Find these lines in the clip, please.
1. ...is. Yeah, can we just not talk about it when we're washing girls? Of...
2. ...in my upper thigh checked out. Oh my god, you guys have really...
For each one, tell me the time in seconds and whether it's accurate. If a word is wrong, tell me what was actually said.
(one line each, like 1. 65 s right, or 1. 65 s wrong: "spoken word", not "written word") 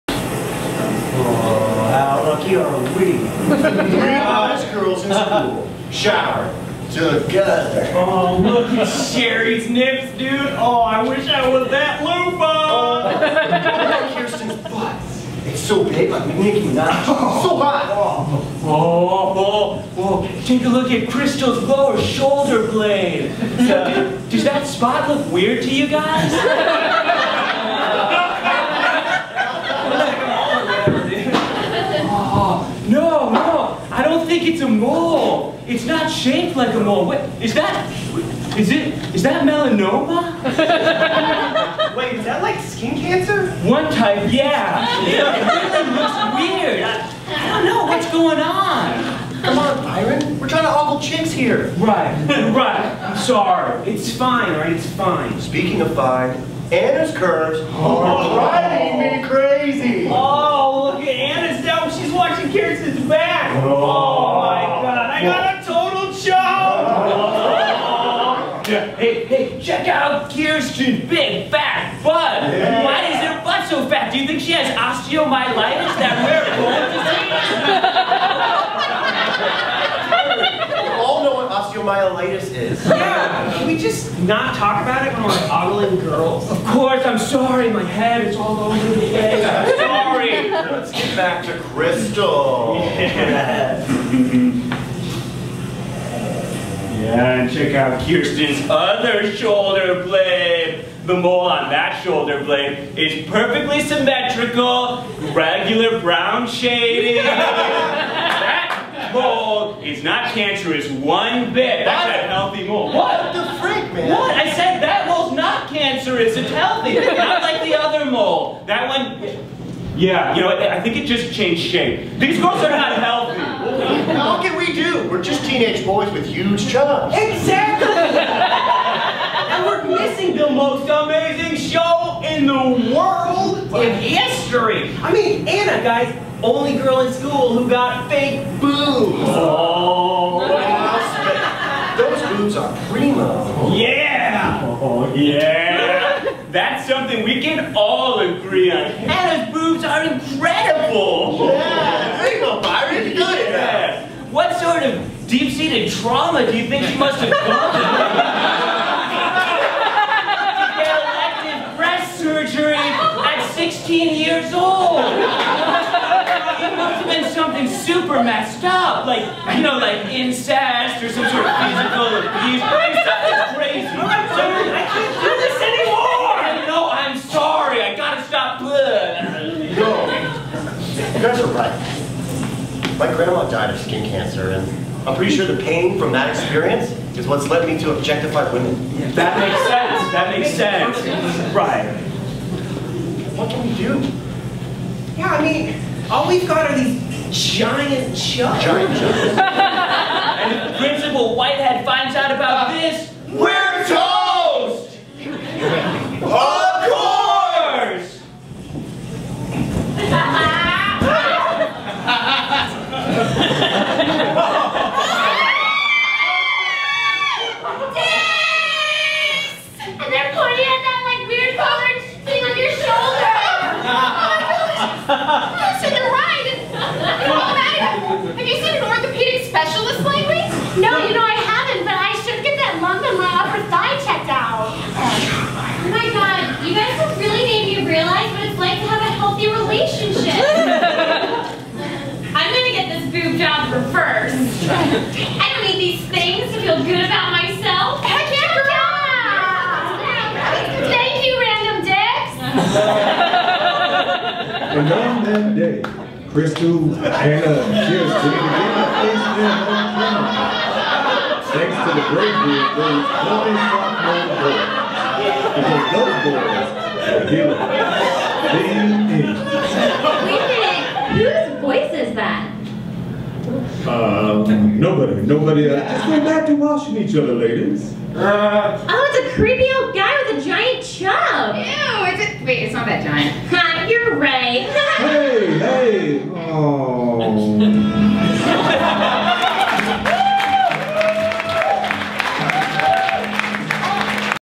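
1. 82 s wrong: "ogling", not "washing"
2. 233 s right.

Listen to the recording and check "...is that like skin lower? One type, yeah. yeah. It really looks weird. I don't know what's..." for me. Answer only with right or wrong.
wrong.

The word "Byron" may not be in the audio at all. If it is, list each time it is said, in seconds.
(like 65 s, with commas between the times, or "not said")
49 s, 152 s.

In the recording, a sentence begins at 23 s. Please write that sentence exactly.
Uh, does that spot look weird to you guys?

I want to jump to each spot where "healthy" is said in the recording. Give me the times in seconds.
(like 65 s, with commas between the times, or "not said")
112 s, 116 s, 122 s, 239 s.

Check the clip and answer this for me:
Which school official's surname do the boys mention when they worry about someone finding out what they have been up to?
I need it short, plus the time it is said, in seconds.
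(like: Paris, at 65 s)
Principal Whitehead, at 200 s.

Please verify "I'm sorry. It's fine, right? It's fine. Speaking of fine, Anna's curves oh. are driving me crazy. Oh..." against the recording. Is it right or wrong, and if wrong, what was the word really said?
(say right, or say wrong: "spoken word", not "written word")
right.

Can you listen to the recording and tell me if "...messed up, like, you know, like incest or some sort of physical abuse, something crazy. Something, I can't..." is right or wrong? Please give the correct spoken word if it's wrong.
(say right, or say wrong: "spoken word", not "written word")
right.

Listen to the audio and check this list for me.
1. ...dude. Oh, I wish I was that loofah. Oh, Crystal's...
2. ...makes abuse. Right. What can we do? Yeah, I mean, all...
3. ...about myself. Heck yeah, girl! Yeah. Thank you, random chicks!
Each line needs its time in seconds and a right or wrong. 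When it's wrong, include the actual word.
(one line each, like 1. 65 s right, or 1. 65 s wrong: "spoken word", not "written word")
1. 10 s wrong: "Kirsten", not "Crystal"
2. 190 s wrong: "sense", not "abuse"
3. 247 s wrong: "dicks", not "chicks".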